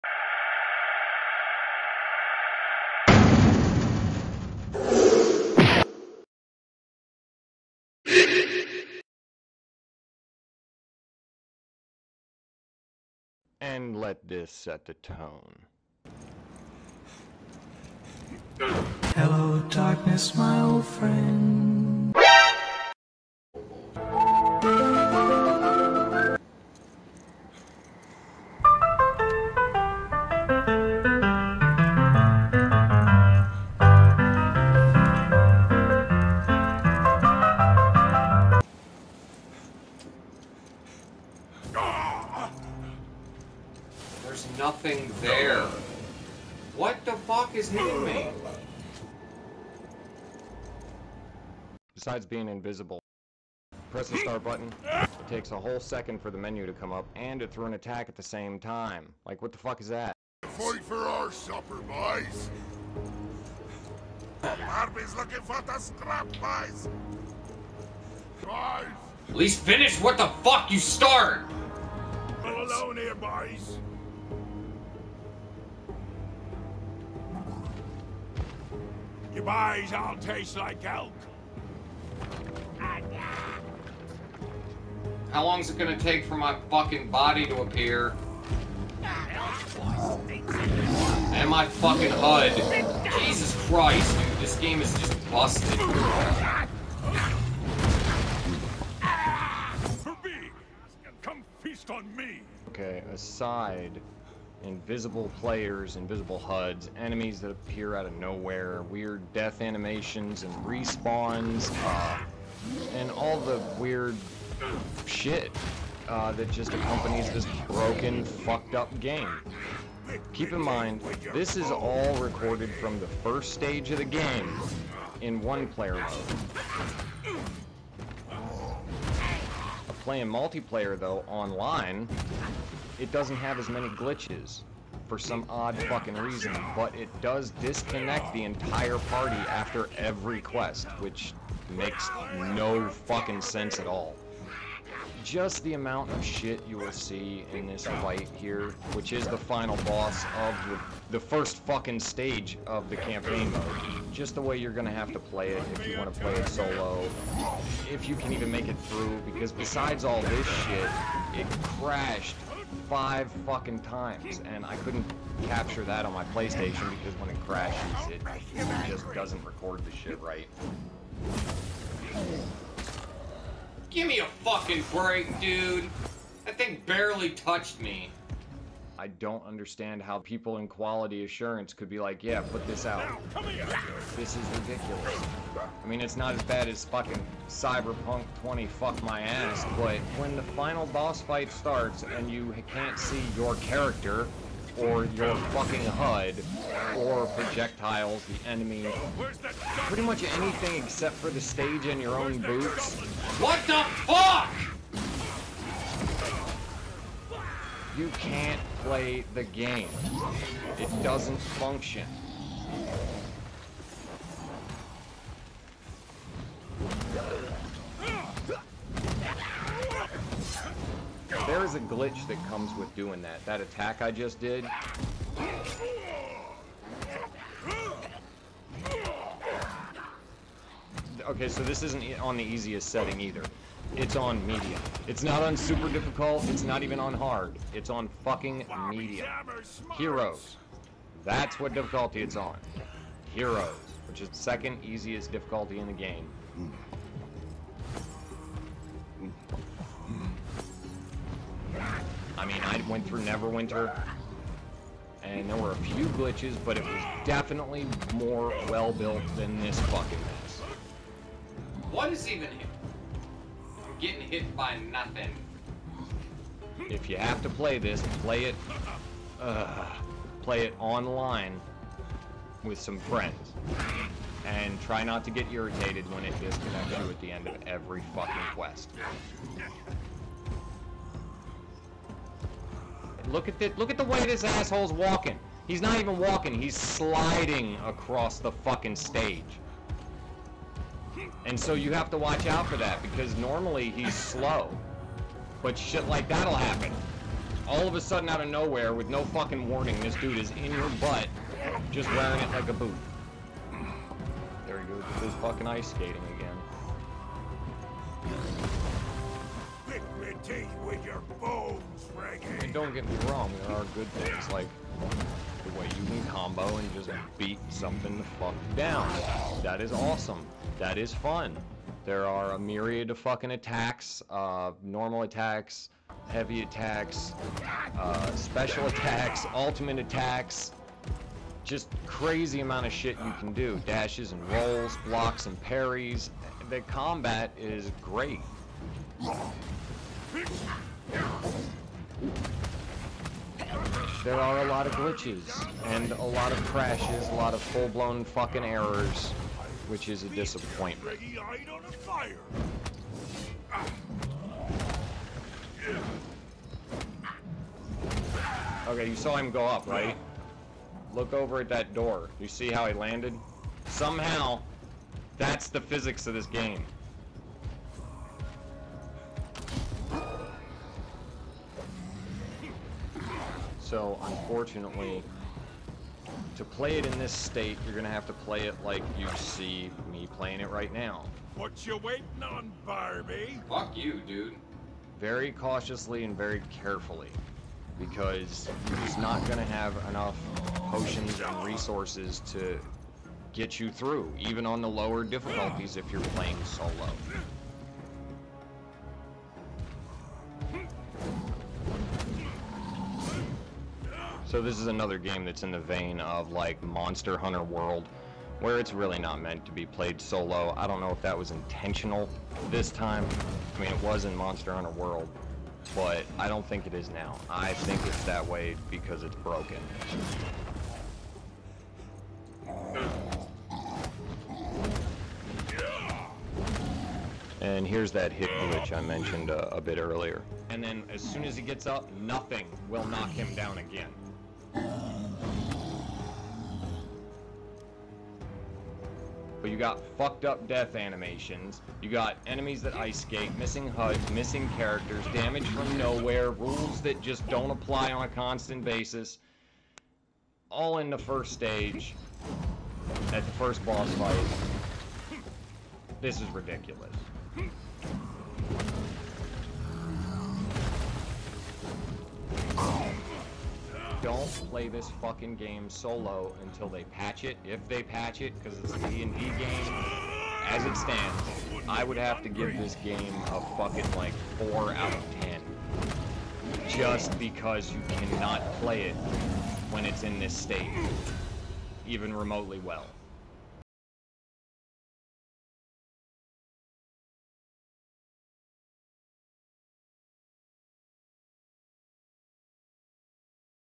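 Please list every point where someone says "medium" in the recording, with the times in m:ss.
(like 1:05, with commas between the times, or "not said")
3:54, 3:58.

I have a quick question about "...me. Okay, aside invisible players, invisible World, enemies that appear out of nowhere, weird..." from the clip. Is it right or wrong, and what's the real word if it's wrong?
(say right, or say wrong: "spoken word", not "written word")
wrong: "HUDs", not "World".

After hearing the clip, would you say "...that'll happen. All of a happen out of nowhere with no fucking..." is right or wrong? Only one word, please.
wrong.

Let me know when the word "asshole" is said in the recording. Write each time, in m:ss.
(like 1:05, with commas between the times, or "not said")
4:44.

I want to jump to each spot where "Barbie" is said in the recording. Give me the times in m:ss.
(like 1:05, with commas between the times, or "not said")
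1:04, 6:22.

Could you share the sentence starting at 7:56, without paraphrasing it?
Just because you cannot play it when it's in this state, even remotely well.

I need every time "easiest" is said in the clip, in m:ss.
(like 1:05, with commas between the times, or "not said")
3:52, 4:04.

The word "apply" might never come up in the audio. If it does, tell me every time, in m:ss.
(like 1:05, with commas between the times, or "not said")
7:27.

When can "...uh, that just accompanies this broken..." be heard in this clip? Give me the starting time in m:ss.
1:56.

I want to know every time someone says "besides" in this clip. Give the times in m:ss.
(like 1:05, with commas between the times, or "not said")
0:51, 2:39.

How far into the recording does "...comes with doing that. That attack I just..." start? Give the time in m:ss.
3:42.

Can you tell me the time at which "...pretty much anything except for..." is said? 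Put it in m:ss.
3:19.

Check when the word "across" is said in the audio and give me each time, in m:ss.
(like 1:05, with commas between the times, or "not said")
4:47.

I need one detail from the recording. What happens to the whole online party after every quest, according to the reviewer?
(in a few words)
It disconnects.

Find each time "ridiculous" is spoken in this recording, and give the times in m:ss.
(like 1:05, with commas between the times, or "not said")
3:04, 7:36.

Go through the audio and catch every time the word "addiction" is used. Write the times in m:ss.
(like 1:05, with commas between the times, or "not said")
not said.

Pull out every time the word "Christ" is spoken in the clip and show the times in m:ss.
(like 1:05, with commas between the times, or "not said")
1:33.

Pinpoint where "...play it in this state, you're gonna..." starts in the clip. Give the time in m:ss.
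6:16.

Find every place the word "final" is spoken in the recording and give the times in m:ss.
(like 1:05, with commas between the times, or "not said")
2:29, 3:10.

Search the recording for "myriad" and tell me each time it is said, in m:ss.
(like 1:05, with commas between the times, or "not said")
5:22.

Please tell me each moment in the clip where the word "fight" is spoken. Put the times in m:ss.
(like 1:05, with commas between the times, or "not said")
1:00, 2:27, 3:11, 7:34.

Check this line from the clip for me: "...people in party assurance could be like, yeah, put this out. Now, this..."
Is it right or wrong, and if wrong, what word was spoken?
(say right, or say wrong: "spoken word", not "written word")
wrong: "quality", not "party".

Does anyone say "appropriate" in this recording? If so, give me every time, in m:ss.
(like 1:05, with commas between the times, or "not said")
not said.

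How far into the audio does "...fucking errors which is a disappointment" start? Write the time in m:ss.
5:48.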